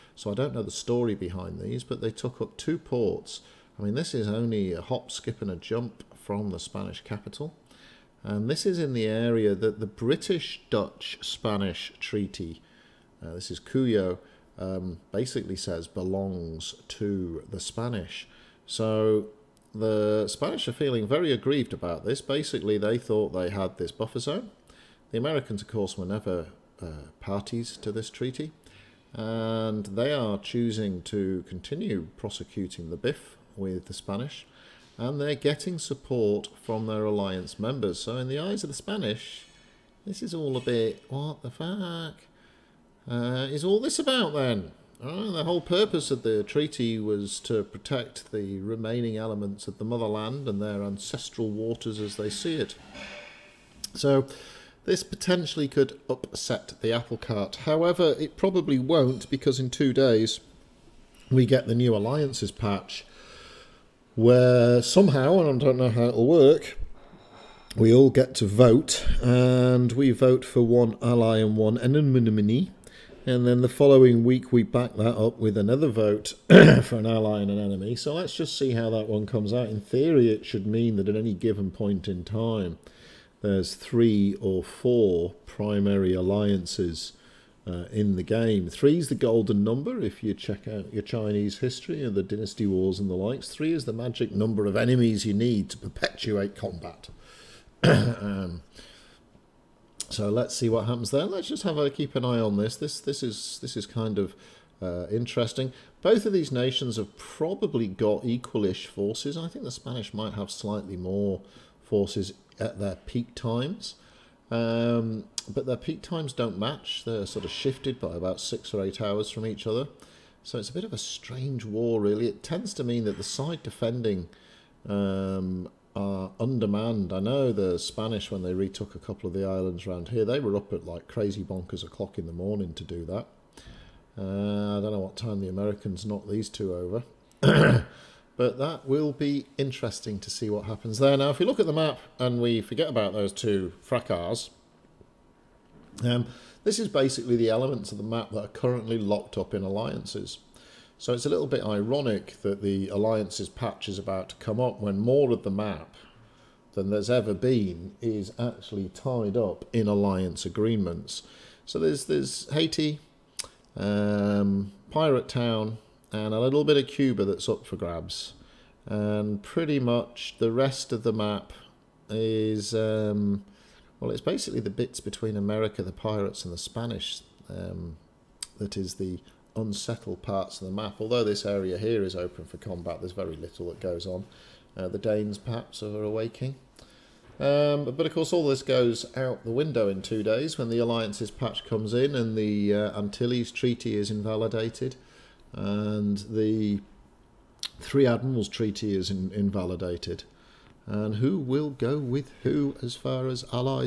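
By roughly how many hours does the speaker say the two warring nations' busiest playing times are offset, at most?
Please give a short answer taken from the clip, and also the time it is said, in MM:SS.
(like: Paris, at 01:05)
8, at 01:58.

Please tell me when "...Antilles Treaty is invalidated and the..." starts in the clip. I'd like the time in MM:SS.
03:12.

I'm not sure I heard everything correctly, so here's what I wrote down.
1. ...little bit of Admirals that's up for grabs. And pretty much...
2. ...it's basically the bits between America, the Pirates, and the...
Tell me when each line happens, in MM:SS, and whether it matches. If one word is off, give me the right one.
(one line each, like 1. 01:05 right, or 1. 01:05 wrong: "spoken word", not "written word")
1. 02:46 wrong: "Cuba", not "Admirals"
2. 02:54 right.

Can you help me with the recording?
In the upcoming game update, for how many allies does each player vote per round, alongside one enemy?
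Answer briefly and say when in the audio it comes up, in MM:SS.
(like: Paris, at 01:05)
1, at 01:10.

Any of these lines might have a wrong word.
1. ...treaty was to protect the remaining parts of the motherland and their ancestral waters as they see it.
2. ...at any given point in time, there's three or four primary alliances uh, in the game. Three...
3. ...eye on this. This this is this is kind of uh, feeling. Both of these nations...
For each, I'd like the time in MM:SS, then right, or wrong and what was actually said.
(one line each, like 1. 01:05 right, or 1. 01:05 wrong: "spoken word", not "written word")
1. 00:46 wrong: "elements", not "parts"
2. 01:21 right
3. 01:42 wrong: "interesting", not "feeling".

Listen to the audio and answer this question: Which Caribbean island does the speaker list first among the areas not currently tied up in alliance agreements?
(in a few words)
Haiti.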